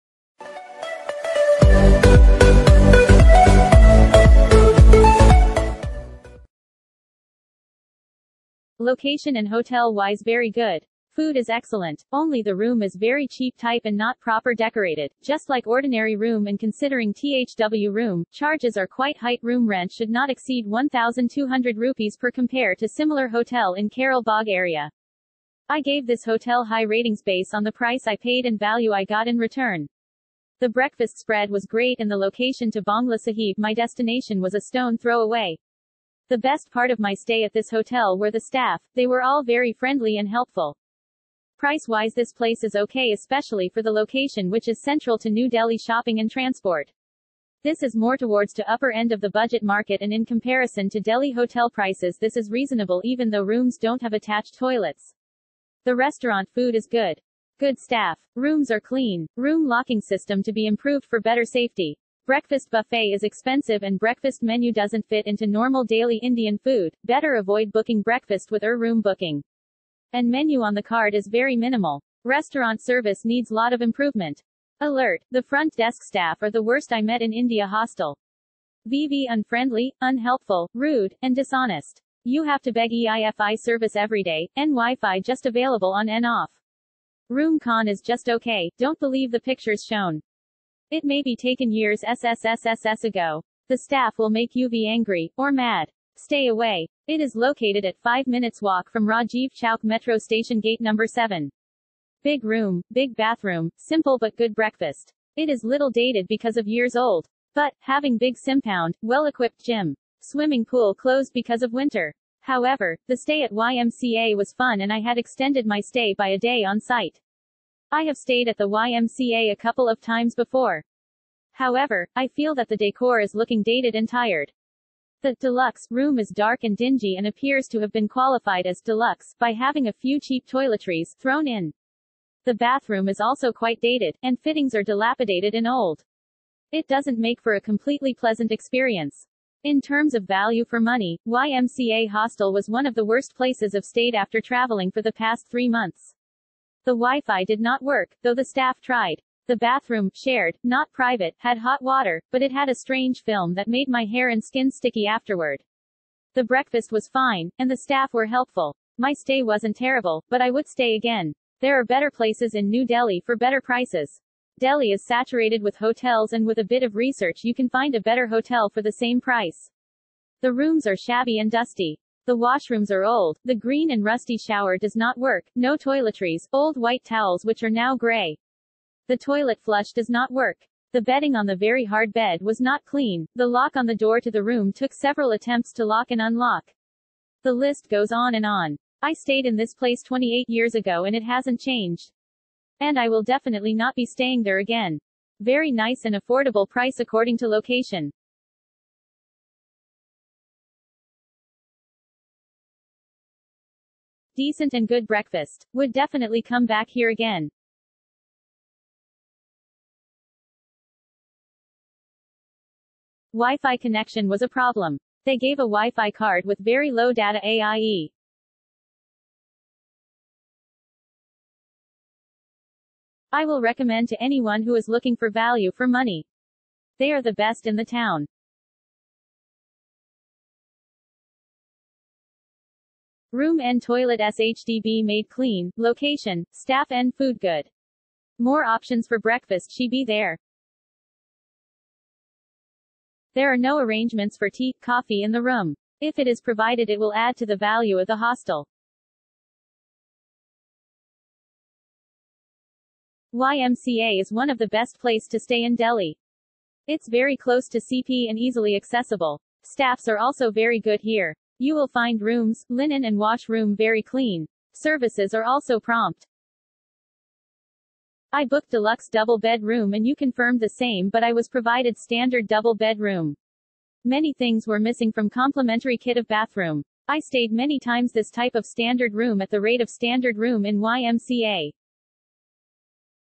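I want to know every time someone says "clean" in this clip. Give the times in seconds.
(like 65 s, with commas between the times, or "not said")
58 s, 182 s, 235 s, 264 s.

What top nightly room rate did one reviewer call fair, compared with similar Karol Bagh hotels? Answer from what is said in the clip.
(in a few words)
1,200 rupees.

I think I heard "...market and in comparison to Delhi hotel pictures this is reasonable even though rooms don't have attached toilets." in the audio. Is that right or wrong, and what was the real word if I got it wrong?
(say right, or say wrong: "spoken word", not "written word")
wrong: "prices", not "pictures".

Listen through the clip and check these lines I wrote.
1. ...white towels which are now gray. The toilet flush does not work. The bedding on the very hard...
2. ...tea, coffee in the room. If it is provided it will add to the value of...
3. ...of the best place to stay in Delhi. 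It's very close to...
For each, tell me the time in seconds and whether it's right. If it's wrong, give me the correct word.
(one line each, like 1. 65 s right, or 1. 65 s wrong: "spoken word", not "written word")
1. 176 s right
2. 244 s right
3. 254 s right.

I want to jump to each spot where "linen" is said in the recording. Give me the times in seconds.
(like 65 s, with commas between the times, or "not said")
262 s.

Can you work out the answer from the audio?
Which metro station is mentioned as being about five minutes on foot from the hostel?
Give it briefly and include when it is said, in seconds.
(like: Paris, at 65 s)
Rajiv Chowk, at 99 s.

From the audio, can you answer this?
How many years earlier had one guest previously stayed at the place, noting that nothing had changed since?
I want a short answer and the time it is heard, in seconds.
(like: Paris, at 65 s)
28, at 190 s.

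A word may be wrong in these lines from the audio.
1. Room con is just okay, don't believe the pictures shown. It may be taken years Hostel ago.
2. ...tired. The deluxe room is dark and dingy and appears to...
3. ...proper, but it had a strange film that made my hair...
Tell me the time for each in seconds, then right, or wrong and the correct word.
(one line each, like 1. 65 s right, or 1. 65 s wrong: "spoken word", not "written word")
1. 87 s wrong: "SSSSS", not "Hostel"
2. 124 s right
3. 151 s wrong: "water", not "proper".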